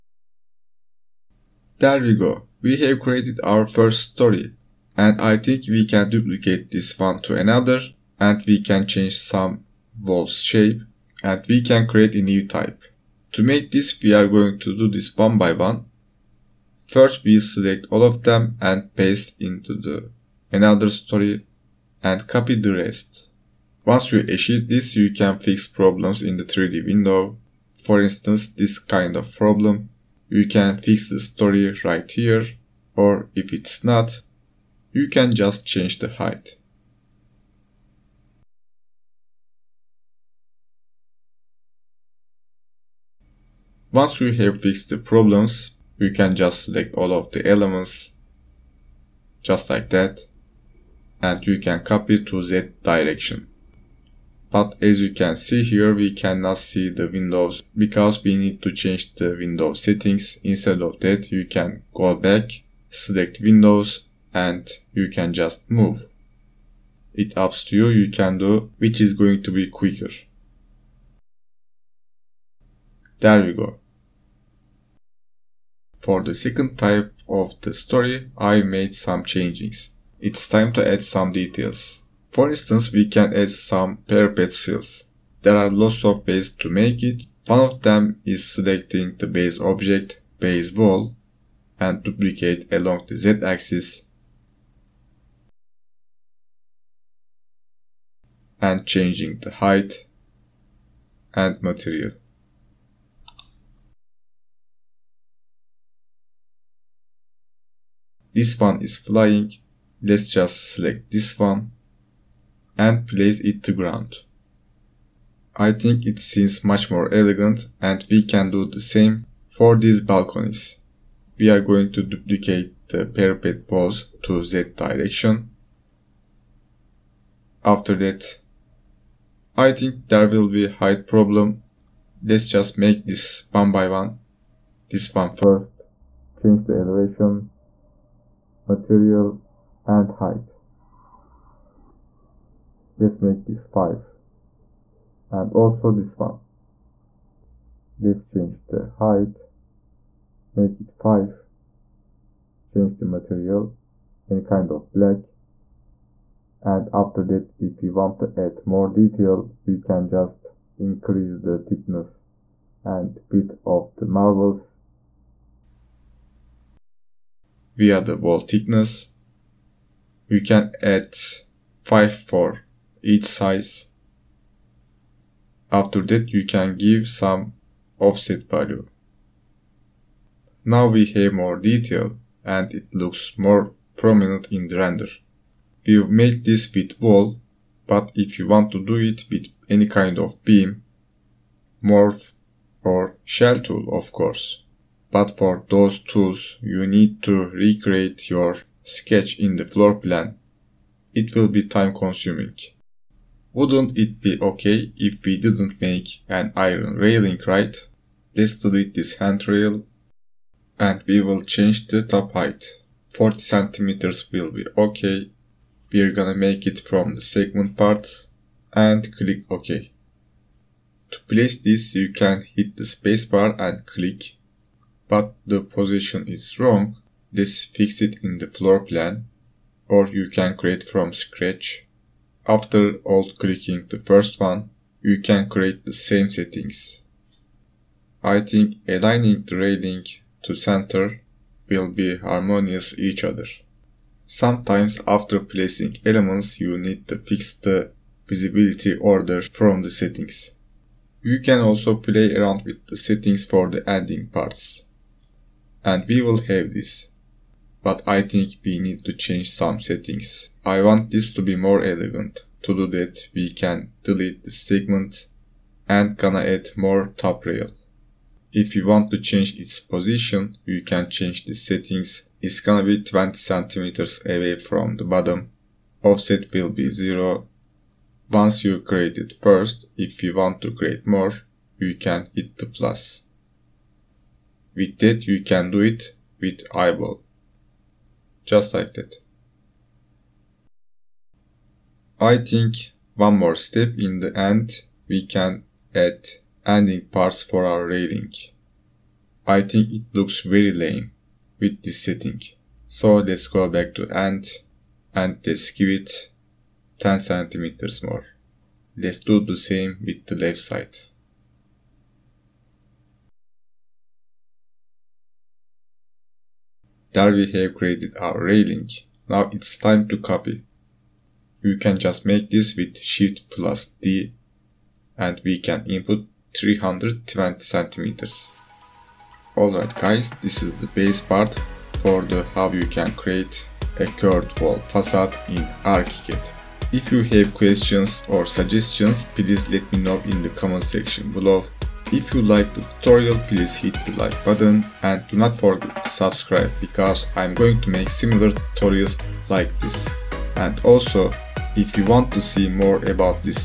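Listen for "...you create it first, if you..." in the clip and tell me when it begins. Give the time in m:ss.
4:38.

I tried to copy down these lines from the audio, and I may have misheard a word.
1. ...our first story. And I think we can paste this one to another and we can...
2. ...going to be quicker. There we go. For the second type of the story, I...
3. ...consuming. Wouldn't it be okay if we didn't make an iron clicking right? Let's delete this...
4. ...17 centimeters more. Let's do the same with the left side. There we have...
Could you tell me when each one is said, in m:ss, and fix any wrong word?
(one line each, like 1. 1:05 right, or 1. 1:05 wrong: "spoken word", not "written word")
1. 0:03 wrong: "duplicate", not "paste"
2. 1:09 right
3. 3:21 wrong: "railing", not "clicking"
4. 5:06 wrong: "10", not "17".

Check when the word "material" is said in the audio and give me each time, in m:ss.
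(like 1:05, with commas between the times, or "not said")
1:41, 2:18, 2:33.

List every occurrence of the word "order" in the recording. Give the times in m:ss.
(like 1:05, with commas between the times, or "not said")
4:08.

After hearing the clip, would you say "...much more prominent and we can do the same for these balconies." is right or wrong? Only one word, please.
wrong.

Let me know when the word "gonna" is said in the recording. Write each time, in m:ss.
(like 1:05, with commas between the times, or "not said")
3:36, 4:26, 4:32.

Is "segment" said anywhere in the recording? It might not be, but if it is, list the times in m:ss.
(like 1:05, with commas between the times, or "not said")
3:37, 4:24.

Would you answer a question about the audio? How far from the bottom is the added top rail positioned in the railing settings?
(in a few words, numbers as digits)
20 centimeters.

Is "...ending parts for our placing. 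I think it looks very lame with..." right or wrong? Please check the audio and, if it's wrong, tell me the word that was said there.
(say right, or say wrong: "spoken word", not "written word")
wrong: "railing", not "placing".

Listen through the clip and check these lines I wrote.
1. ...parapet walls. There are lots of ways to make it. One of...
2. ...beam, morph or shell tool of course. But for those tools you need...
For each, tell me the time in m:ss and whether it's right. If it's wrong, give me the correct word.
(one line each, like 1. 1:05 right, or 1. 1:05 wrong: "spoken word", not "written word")
1. 1:24 wrong: "seals", not "walls"
2. 3:10 right.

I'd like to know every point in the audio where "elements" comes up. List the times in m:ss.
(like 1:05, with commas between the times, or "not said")
0:47, 4:06.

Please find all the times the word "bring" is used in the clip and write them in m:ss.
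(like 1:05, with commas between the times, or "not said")
not said.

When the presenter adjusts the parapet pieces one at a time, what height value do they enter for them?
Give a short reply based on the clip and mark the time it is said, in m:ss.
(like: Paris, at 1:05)
5, at 2:22.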